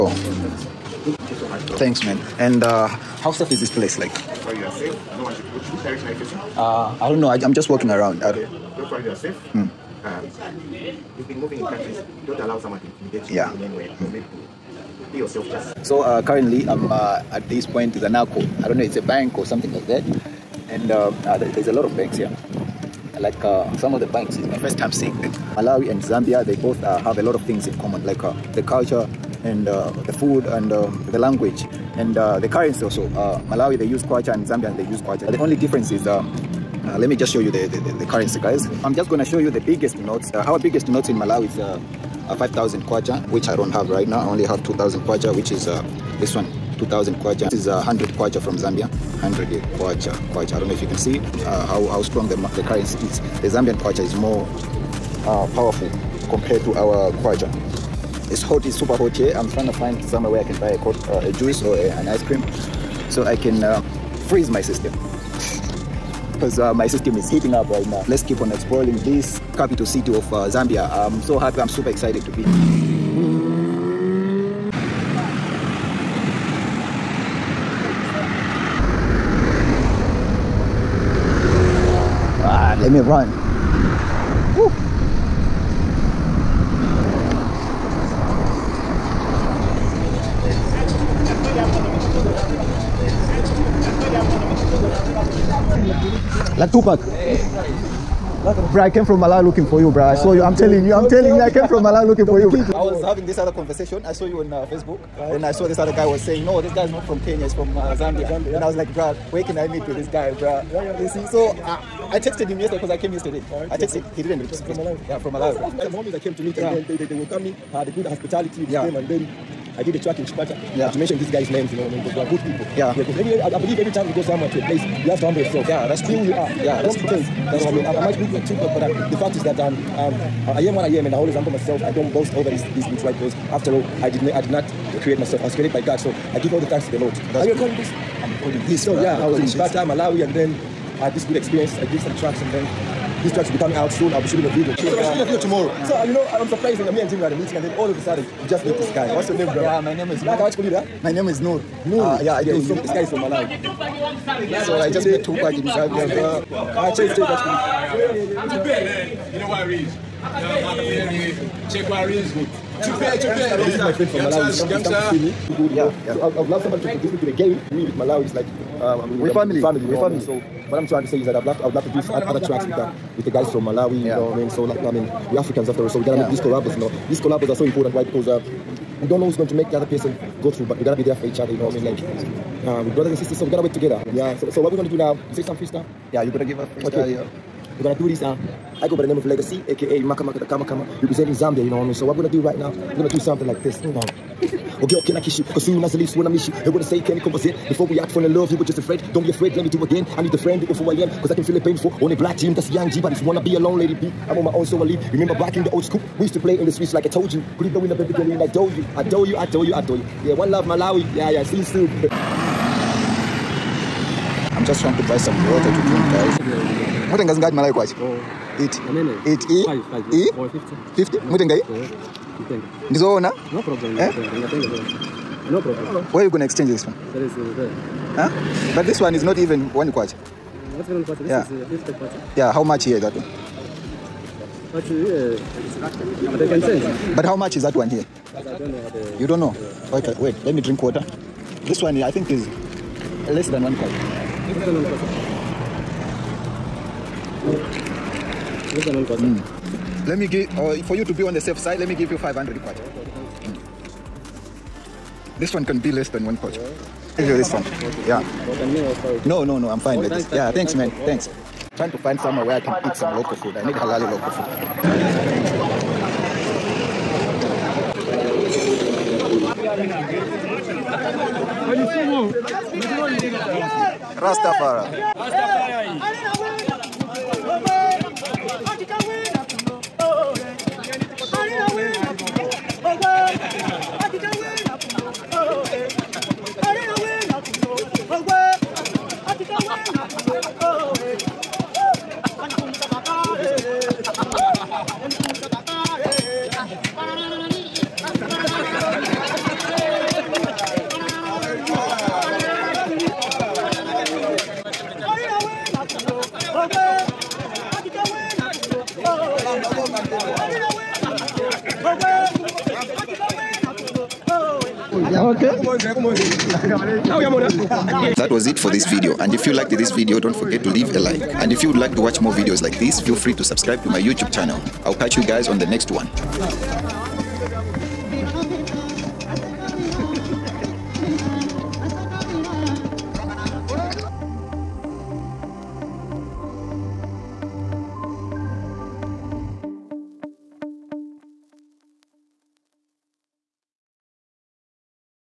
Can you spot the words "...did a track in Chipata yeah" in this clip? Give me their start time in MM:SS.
01:59.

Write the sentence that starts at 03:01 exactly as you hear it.
Like, uh, with brothers and sisters.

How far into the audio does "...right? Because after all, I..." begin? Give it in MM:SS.
02:13.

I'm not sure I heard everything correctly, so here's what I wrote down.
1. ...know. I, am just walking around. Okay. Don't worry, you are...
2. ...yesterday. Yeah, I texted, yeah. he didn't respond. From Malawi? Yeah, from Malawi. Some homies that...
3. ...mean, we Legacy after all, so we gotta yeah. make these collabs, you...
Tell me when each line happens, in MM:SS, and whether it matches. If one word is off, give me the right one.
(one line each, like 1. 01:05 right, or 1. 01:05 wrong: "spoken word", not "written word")
1. 00:07 right
2. 01:53 right
3. 02:54 wrong: "Africans", not "Legacy".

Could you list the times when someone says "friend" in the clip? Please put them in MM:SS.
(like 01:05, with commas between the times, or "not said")
02:43, 03:20.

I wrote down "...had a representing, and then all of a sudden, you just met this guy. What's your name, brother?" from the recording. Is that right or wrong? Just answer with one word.
wrong.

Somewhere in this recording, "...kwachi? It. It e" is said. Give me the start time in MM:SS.
03:37.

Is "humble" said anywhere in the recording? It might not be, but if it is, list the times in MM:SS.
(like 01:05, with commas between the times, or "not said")
02:05, 02:11.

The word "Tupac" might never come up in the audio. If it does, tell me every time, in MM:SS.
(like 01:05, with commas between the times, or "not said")
01:36, 02:35.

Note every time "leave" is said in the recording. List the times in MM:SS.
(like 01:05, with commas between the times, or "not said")
03:15, 03:24, 05:20.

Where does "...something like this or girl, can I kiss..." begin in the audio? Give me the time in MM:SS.
03:13.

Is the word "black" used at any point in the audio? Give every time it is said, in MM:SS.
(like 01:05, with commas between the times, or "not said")
03:22.